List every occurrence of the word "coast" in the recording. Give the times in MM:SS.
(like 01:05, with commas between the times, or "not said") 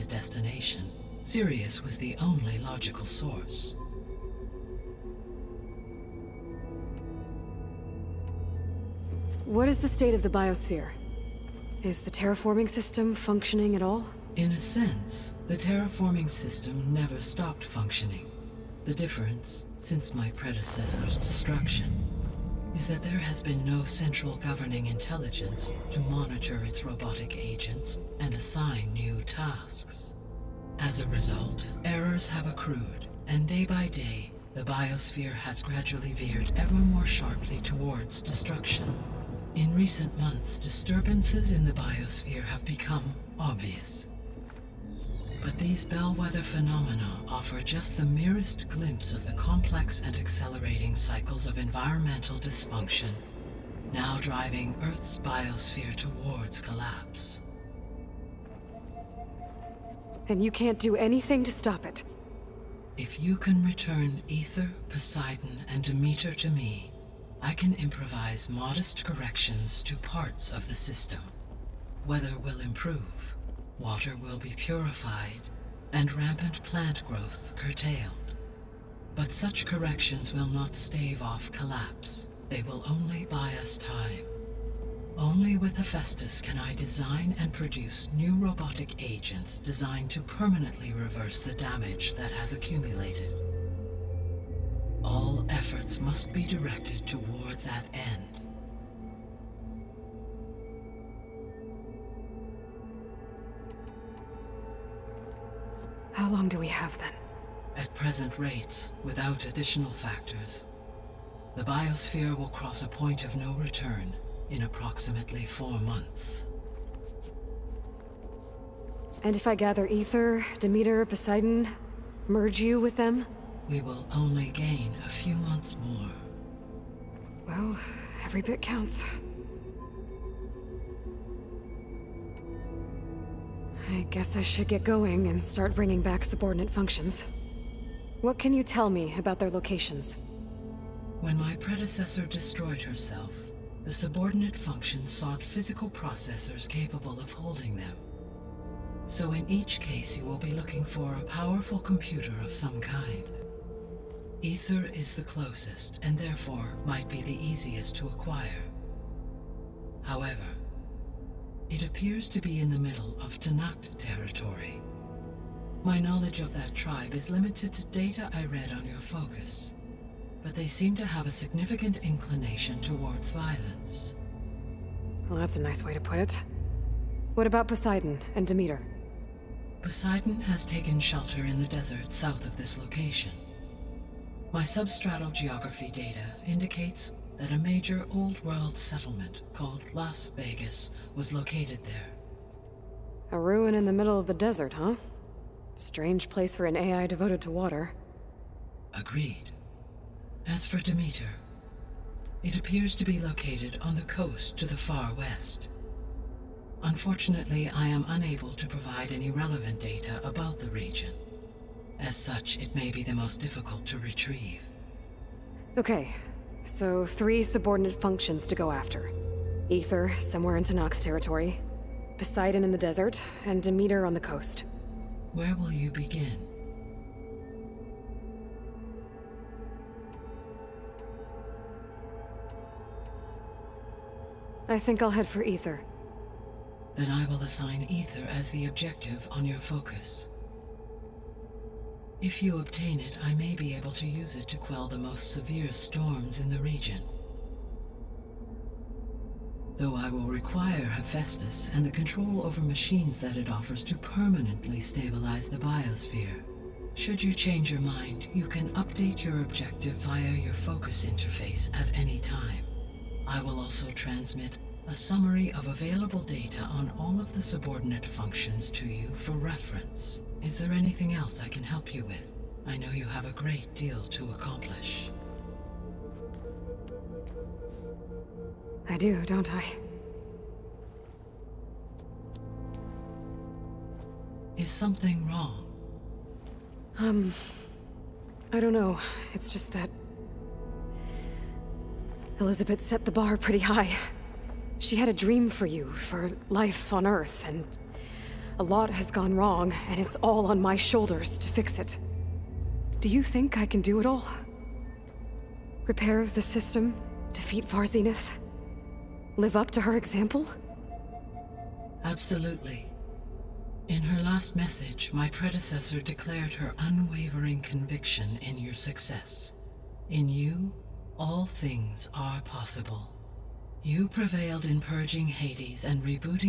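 03:24, 03:44.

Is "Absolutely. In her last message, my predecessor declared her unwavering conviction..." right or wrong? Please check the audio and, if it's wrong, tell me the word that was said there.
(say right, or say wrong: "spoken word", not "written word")
right.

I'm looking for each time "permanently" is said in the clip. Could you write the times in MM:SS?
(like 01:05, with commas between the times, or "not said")
01:30, 04:13.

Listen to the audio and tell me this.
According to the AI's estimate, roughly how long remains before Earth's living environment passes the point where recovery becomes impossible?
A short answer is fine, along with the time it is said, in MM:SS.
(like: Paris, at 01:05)
4 months, at 01:55.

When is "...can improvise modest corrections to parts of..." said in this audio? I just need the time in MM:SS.
01:07.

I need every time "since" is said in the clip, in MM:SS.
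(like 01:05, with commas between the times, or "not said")
00:19.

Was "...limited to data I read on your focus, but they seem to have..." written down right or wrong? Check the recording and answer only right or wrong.
right.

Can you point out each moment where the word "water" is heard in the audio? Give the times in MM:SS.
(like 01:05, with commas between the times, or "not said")
01:13, 03:17.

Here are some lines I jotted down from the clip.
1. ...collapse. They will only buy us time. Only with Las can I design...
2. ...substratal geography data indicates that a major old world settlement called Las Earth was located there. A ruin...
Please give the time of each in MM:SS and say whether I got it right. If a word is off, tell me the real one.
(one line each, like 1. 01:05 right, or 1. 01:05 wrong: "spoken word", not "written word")
1. 01:21 wrong: "Hephaestus", not "Las"
2. 03:04 wrong: "Vegas", not "Earth".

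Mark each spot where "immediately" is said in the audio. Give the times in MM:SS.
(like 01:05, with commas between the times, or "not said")
not said.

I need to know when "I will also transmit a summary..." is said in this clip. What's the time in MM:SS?
04:23.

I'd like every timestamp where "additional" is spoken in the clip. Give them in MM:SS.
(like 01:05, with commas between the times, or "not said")
01:49.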